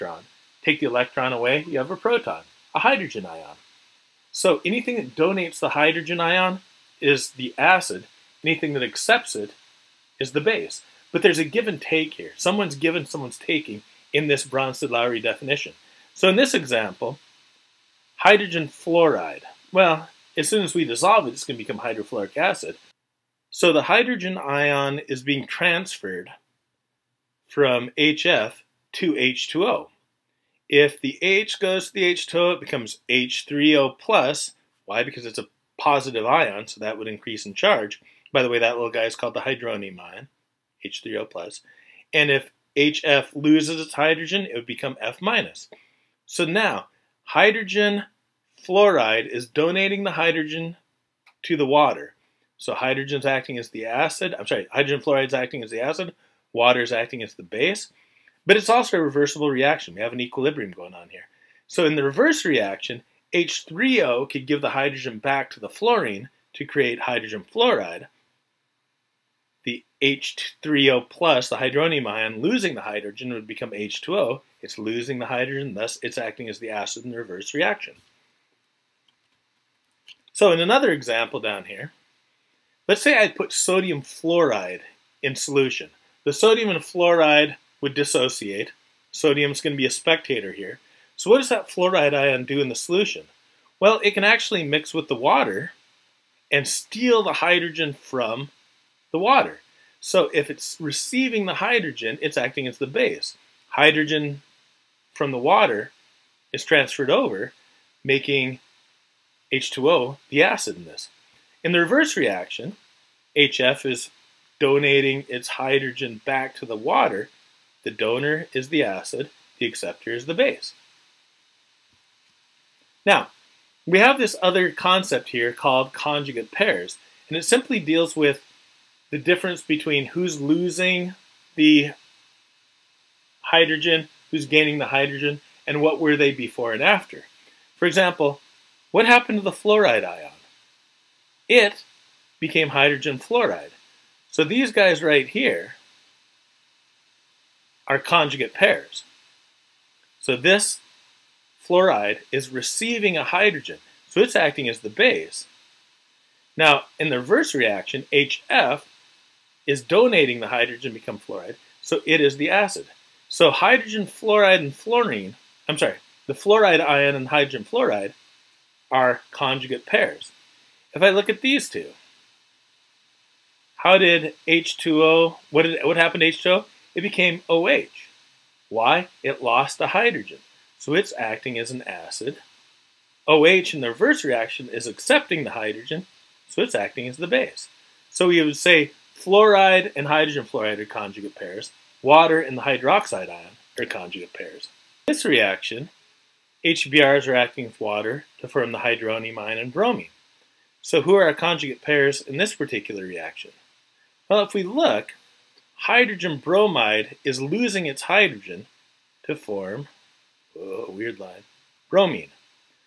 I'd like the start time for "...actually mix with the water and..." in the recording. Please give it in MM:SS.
01:34.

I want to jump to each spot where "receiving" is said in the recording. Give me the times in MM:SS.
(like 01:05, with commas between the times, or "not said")
01:40, 02:32.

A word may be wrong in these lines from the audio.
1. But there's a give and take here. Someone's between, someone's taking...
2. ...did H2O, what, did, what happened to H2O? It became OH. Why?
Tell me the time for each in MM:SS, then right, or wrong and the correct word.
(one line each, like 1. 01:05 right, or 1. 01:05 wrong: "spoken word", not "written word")
1. 00:11 wrong: "given", not "between"
2. 02:53 right.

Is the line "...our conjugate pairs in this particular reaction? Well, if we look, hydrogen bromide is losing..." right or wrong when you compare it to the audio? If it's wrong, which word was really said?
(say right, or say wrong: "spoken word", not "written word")
right.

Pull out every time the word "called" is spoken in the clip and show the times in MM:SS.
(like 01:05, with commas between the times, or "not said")
00:39, 02:05.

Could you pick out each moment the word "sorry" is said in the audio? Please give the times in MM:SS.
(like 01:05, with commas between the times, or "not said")
00:54, 02:45.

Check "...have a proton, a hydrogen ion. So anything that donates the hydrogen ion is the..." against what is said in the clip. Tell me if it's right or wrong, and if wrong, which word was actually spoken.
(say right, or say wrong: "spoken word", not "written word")
right.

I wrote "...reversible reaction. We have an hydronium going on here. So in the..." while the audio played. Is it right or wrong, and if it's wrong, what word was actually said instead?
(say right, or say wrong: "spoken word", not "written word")
wrong: "equilibrium", not "hydronium".